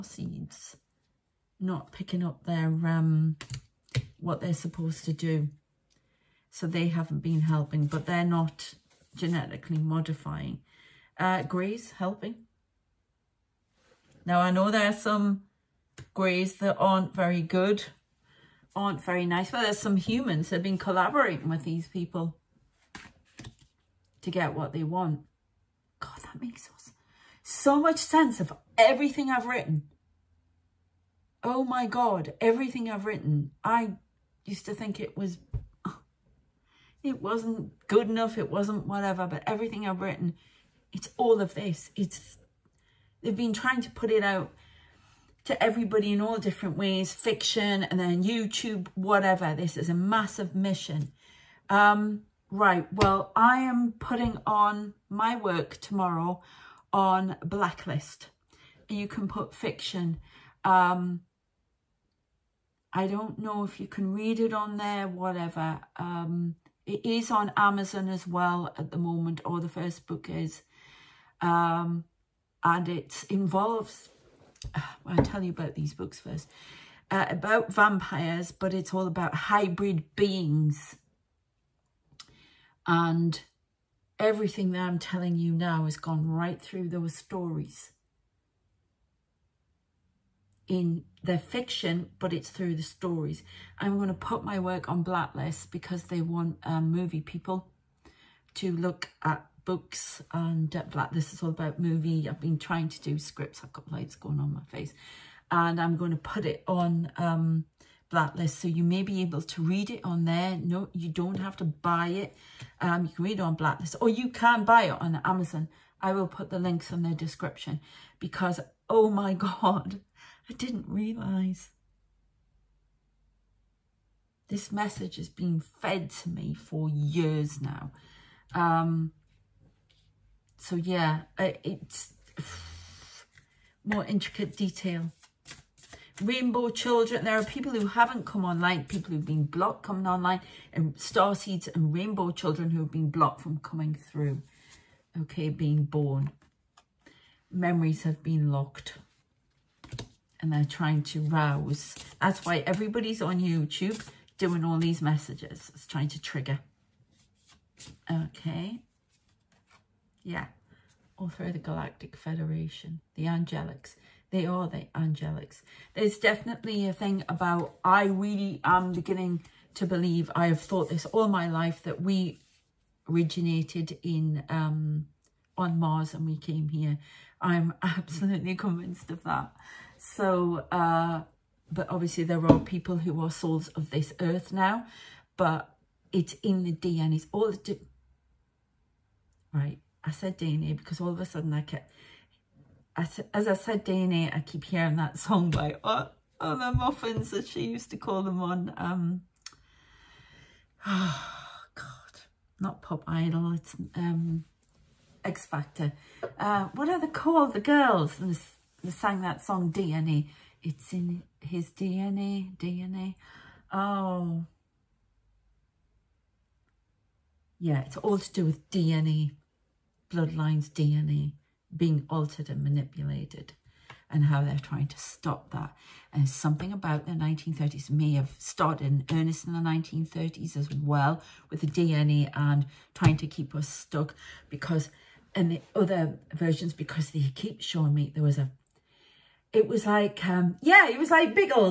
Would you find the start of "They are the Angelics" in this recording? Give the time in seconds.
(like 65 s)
164 s.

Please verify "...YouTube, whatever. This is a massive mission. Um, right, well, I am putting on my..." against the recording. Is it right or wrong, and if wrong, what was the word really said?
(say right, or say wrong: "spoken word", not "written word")
right.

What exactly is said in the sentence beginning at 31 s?
Oh my God, everything I've written.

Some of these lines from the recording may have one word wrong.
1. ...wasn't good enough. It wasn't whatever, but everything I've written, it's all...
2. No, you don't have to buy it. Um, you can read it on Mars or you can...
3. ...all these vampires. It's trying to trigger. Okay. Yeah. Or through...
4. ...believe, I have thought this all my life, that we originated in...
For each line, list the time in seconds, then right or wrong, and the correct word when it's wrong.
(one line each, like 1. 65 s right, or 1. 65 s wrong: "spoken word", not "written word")
1. 37 s right
2. 110 s wrong: "Blacklist", not "Mars"
3. 154 s wrong: "messages", not "vampires"
4. 169 s right.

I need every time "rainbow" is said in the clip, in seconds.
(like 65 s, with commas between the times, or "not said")
136 s, 141 s.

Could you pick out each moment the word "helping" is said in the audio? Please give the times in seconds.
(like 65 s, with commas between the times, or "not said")
7 s, 11 s.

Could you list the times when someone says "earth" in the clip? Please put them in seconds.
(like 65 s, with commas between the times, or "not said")
184 s.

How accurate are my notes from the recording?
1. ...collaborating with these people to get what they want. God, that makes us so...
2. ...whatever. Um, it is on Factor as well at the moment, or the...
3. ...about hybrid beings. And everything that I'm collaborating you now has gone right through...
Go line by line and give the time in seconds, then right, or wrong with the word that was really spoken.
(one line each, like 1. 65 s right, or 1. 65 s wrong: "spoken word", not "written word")
1. 20 s right
2. 65 s wrong: "Amazon", not "Factor"
3. 79 s wrong: "telling", not "collaborating".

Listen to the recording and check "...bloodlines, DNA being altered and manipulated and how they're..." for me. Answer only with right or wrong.
right.